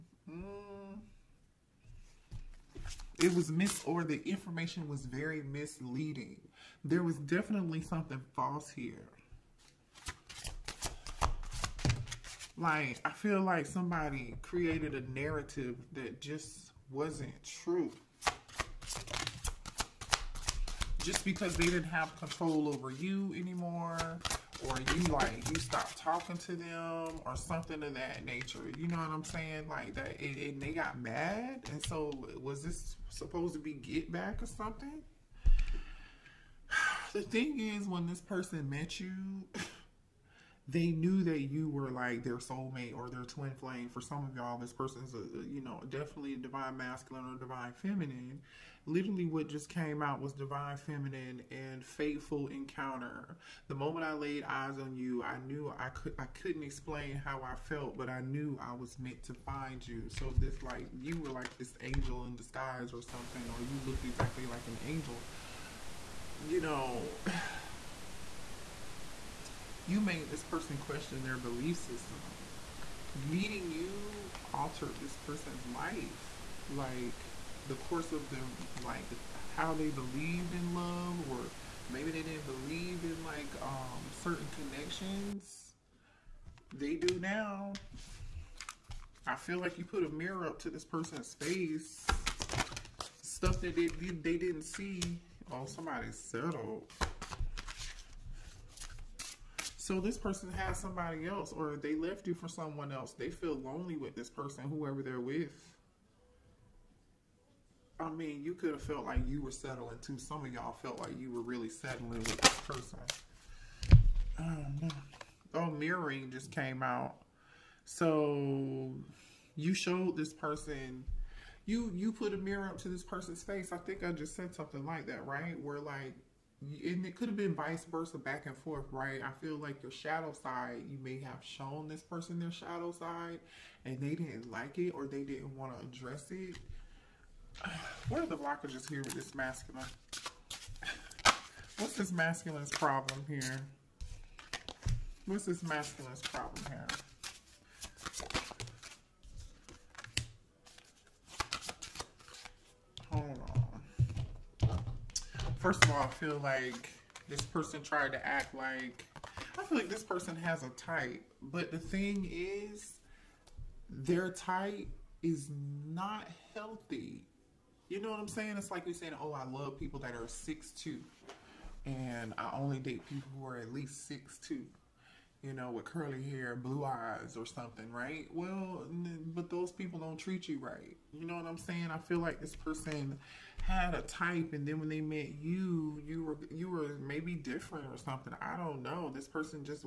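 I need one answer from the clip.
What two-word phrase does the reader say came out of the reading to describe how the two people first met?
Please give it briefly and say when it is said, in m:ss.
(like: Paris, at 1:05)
fateful encounter, at 0:51.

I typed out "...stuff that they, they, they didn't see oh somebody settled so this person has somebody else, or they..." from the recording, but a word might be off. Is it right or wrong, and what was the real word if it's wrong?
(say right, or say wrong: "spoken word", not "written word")
right.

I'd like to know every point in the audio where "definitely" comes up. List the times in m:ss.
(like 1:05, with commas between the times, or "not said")
0:07, 0:45.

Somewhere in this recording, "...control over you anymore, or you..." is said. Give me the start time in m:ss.
0:22.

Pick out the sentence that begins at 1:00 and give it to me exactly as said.
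So this like you were like this angel in disguise or something, or you looked exactly like an angel.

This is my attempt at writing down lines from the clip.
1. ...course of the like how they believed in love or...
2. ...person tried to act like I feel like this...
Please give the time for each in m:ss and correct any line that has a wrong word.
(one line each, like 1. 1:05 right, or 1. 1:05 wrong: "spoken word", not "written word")
1. 1:17 right
2. 2:37 right.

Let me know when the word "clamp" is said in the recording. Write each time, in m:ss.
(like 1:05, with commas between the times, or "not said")
not said.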